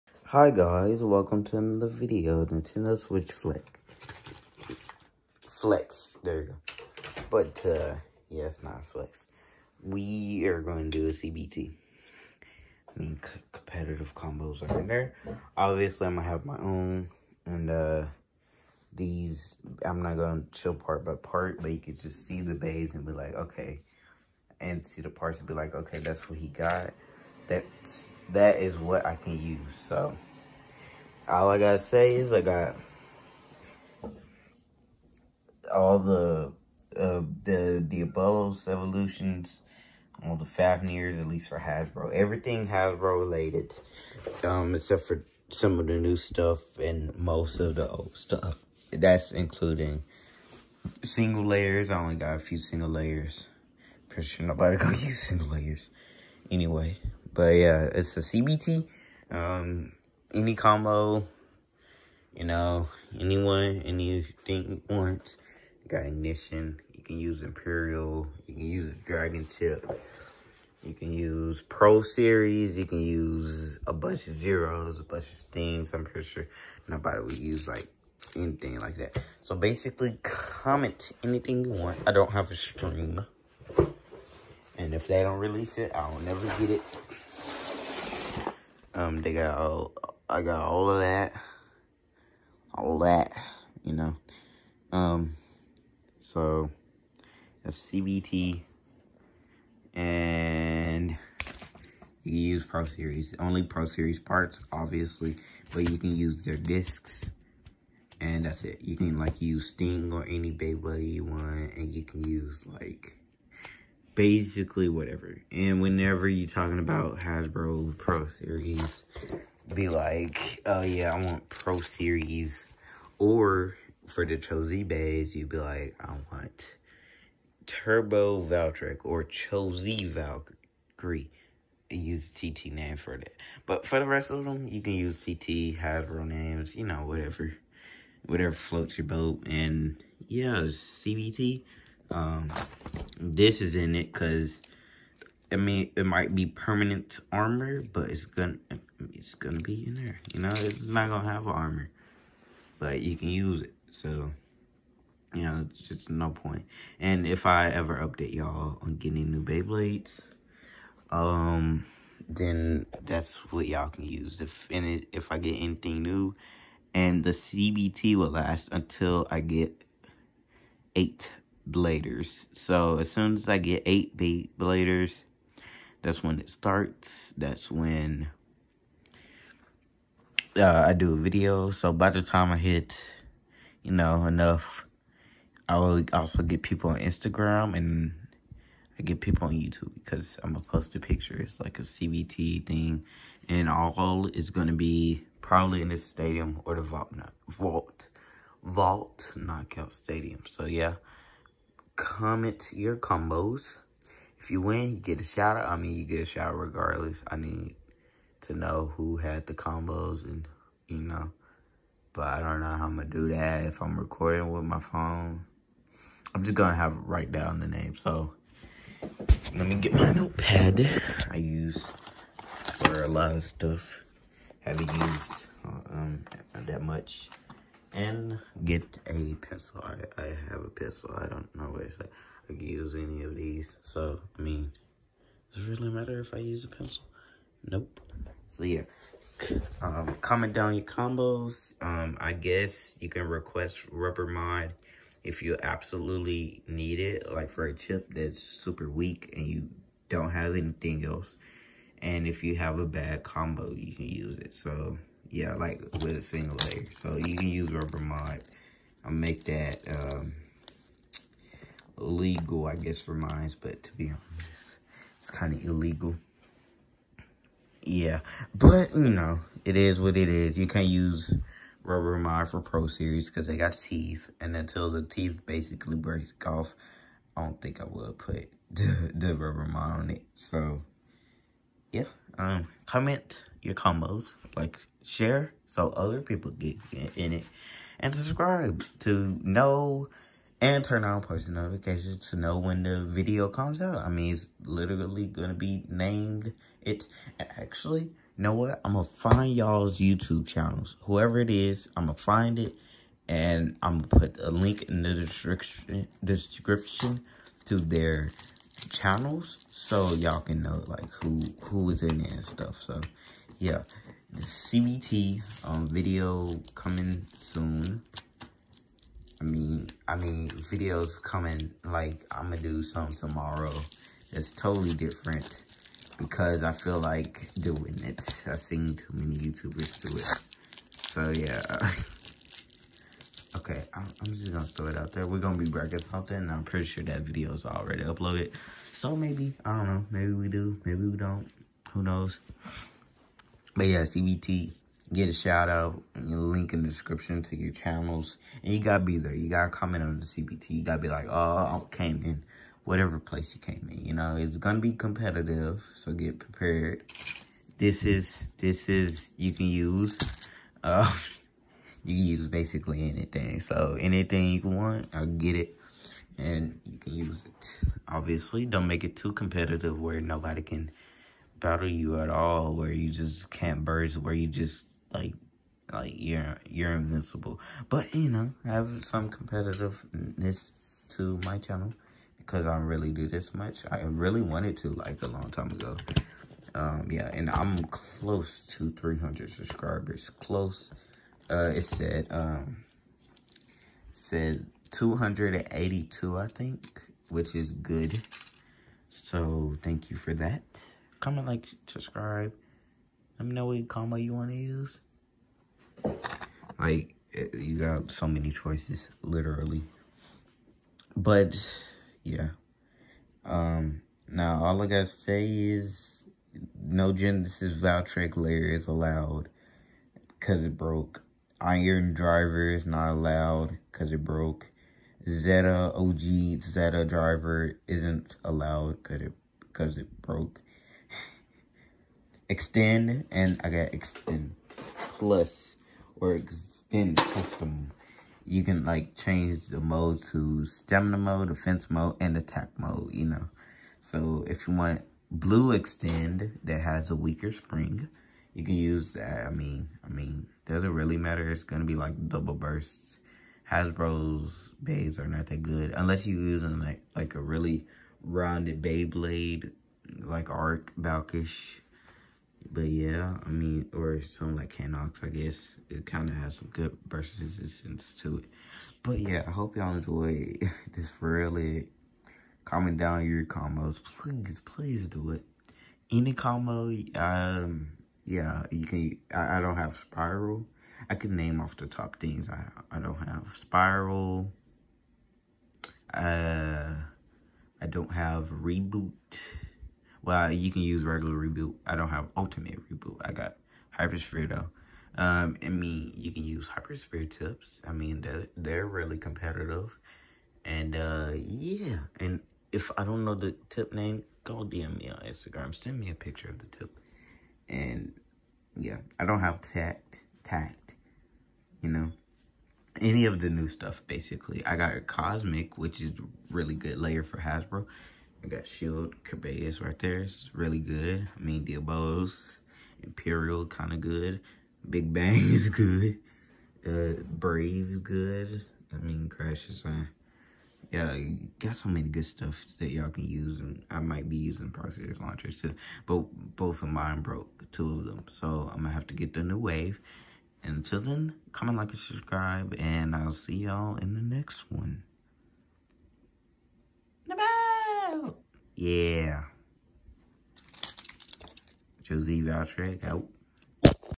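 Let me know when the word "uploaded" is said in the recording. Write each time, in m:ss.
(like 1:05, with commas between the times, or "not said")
5:38.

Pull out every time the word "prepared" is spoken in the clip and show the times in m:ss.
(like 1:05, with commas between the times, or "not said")
5:56.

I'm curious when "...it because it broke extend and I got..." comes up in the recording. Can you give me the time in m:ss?
7:09.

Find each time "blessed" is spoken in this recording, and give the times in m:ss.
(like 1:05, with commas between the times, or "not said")
not said.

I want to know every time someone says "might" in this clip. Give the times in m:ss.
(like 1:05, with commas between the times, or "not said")
2:26, 8:53.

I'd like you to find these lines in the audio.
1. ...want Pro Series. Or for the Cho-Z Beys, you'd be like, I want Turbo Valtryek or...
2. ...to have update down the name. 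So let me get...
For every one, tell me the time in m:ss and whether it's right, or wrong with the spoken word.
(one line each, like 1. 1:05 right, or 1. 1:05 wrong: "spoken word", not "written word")
1. 2:01 right
2. 3:36 wrong: "write", not "update".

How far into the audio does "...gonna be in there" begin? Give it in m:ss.
2:29.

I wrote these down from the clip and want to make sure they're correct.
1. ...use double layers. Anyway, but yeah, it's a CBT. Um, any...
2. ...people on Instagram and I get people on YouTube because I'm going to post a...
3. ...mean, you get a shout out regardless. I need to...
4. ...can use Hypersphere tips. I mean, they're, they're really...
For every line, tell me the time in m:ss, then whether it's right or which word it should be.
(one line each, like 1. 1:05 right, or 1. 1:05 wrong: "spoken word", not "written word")
1. 0:54 wrong: "single", not "double"
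2. 3:06 right
3. 3:25 right
4. 8:16 right.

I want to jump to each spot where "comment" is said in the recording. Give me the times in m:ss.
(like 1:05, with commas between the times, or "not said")
1:20, 3:22, 4:00, 4:42, 5:49, 6:41, 7:52, 9:01.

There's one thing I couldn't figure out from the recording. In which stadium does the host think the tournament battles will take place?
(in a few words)
knockout stadium.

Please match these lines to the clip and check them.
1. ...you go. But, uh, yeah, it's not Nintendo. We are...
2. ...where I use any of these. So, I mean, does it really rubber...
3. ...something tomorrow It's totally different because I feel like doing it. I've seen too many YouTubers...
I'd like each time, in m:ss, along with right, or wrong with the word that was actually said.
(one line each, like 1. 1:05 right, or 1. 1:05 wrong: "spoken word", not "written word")
1. 0:06 wrong: "Flex", not "Nintendo"
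2. 3:51 wrong: "matter", not "rubber"
3. 5:22 right.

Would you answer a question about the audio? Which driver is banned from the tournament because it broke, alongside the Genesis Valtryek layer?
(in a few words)
Iron Driver.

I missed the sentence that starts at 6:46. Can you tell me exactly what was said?
Like, eh, you got so many choices, literally.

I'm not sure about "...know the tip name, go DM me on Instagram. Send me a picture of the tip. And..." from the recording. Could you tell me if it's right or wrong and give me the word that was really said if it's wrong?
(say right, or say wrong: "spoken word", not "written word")
right.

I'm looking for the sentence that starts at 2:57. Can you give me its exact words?
That's when uh, I do a video.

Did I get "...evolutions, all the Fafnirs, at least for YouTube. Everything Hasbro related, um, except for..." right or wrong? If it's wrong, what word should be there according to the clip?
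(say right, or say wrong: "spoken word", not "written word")
wrong: "Hasbro", not "YouTube".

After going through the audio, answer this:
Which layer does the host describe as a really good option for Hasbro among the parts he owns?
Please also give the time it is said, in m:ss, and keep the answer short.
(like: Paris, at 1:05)
Cosmic, at 8:35.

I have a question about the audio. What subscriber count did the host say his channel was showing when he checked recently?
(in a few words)
282.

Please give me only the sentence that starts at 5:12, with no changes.
So yeah, the CBT um, video coming soon.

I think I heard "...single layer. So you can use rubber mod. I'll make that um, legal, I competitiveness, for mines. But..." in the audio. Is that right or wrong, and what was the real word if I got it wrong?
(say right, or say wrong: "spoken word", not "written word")
wrong: "guess", not "competitiveness".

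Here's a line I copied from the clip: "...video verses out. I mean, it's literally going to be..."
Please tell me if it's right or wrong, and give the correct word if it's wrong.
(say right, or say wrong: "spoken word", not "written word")
wrong: "comes", not "verses".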